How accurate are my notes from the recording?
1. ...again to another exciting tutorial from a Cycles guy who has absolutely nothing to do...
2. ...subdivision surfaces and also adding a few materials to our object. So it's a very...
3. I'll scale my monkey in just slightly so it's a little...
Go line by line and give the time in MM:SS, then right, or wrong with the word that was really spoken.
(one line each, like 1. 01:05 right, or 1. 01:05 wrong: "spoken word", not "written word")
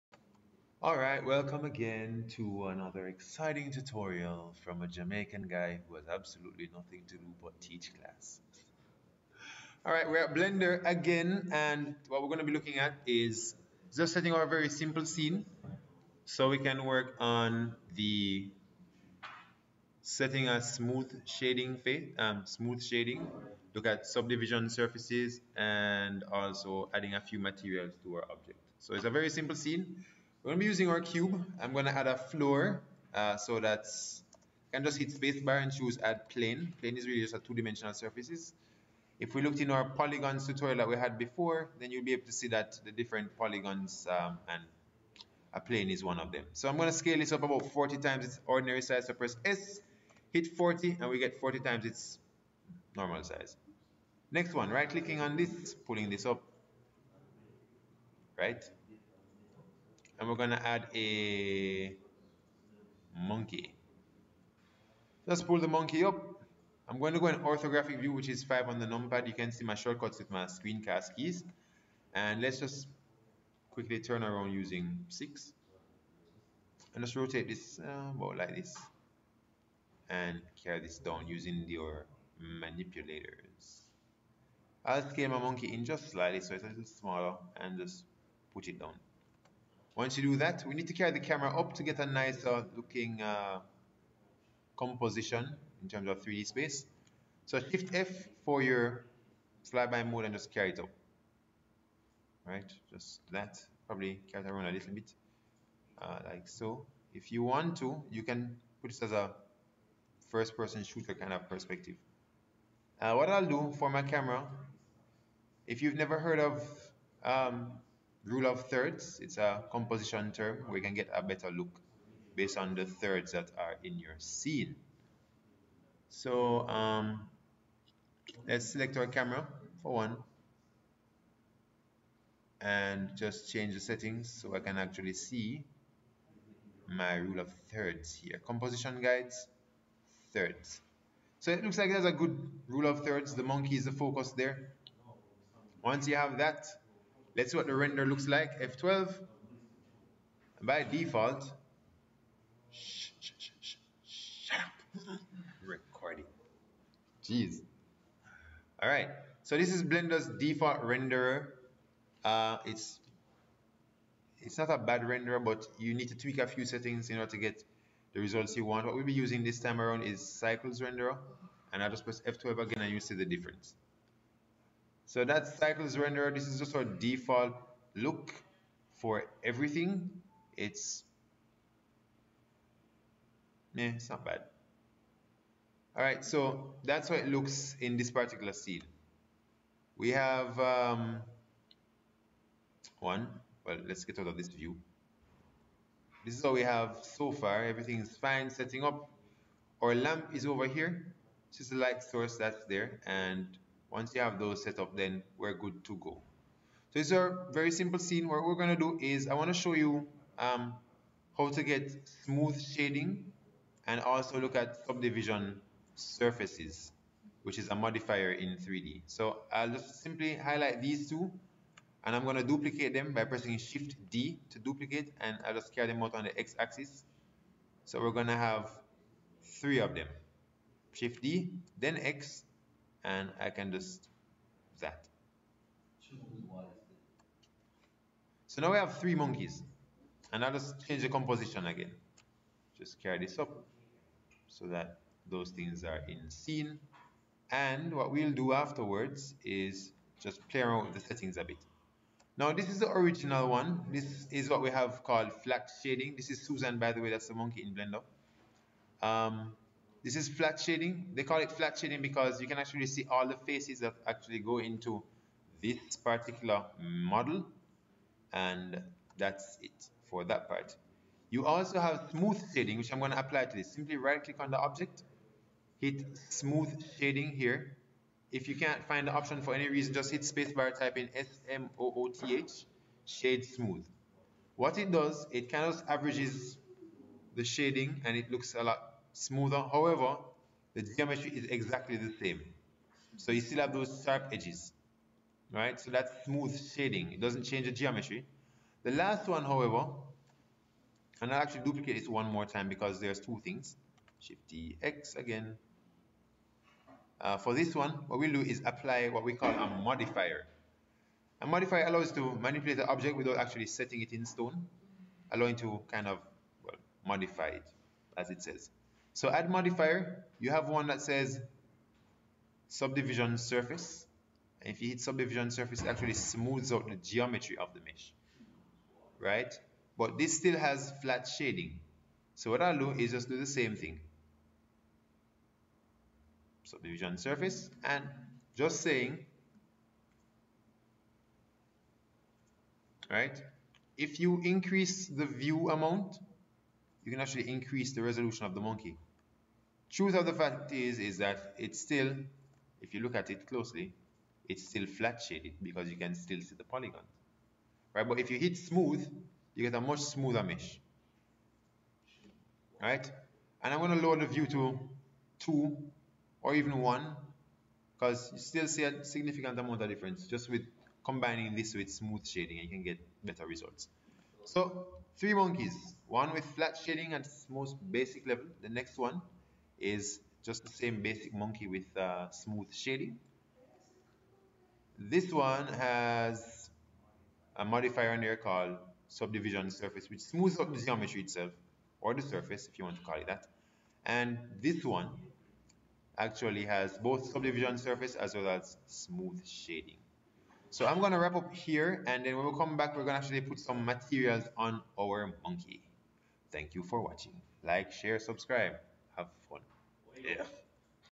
1. 00:01 wrong: "Jamaican", not "Cycles"
2. 00:24 right
3. 01:24 right.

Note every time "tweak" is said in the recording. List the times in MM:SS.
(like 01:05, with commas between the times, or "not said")
02:46.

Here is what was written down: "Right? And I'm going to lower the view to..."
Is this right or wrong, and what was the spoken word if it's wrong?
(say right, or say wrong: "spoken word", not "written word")
right.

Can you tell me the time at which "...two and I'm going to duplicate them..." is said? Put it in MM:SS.
03:41.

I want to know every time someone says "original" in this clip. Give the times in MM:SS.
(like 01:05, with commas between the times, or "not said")
04:12.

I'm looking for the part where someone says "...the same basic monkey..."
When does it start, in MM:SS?
06:20.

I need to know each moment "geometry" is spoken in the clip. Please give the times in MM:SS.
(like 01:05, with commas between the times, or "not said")
04:50, 04:57, 05:26, 06:30.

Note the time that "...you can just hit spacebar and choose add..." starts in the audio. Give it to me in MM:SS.
00:34.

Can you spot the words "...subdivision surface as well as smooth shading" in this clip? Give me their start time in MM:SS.
06:37.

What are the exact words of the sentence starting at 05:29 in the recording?
But this still has flat shading.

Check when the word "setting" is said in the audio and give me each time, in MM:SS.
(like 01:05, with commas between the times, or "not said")
00:14, 00:20, 02:13, 02:46, 03:18, 04:10, 05:13.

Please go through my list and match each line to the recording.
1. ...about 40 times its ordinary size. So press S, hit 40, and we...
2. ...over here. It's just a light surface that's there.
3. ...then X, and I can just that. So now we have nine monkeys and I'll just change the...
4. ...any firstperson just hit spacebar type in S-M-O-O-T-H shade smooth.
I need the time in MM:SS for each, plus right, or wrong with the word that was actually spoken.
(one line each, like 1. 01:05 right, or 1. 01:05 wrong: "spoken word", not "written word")
1. 00:47 right
2. 03:20 wrong: "source", not "surface"
3. 03:51 wrong: "three", not "nine"
4. 04:39 wrong: "reason", not "firstperson".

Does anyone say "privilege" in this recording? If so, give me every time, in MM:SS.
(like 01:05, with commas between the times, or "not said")
not said.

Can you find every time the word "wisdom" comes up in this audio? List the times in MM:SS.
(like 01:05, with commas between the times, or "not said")
not said.